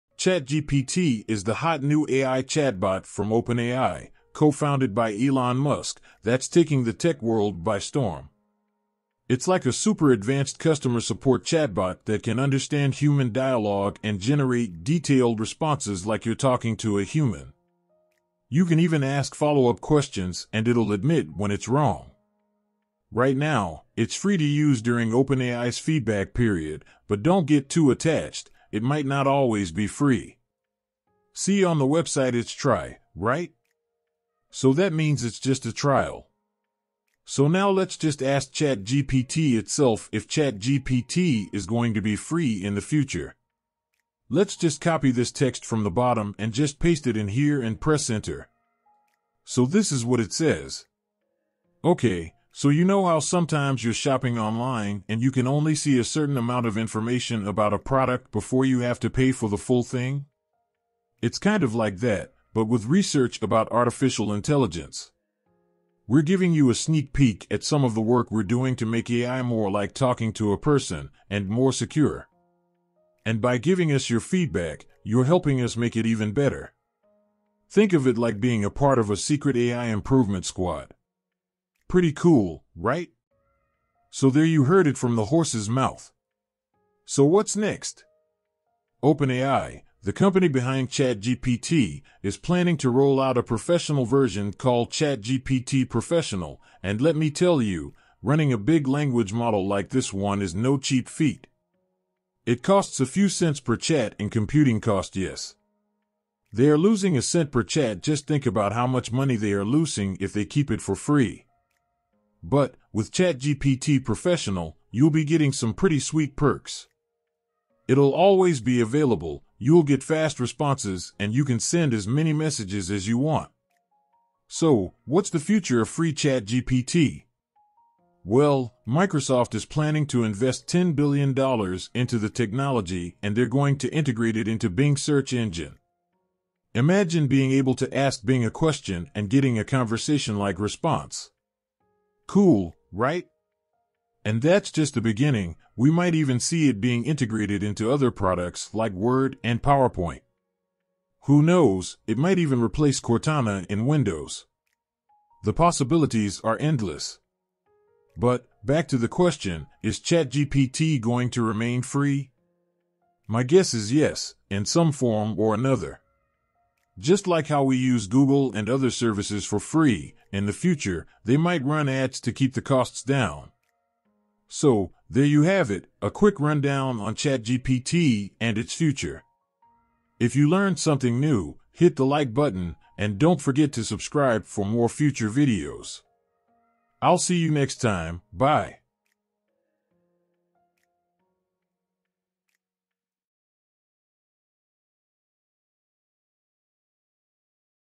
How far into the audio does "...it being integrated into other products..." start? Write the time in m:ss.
2:26.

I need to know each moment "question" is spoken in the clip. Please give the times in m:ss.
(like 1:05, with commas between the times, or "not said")
0:19, 2:18, 2:39.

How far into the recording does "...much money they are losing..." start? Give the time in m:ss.
1:48.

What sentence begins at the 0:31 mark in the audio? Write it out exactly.
See on the website it's try, right?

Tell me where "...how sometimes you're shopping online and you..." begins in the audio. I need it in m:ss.
0:53.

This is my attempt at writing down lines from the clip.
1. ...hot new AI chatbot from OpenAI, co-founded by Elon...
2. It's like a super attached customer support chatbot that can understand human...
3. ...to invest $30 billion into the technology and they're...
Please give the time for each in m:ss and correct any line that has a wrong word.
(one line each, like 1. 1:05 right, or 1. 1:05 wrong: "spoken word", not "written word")
1. 0:01 right
2. 0:09 wrong: "advanced", not "attached"
3. 2:10 wrong: "10", not "30".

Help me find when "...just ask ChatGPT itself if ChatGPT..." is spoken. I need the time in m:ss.
0:37.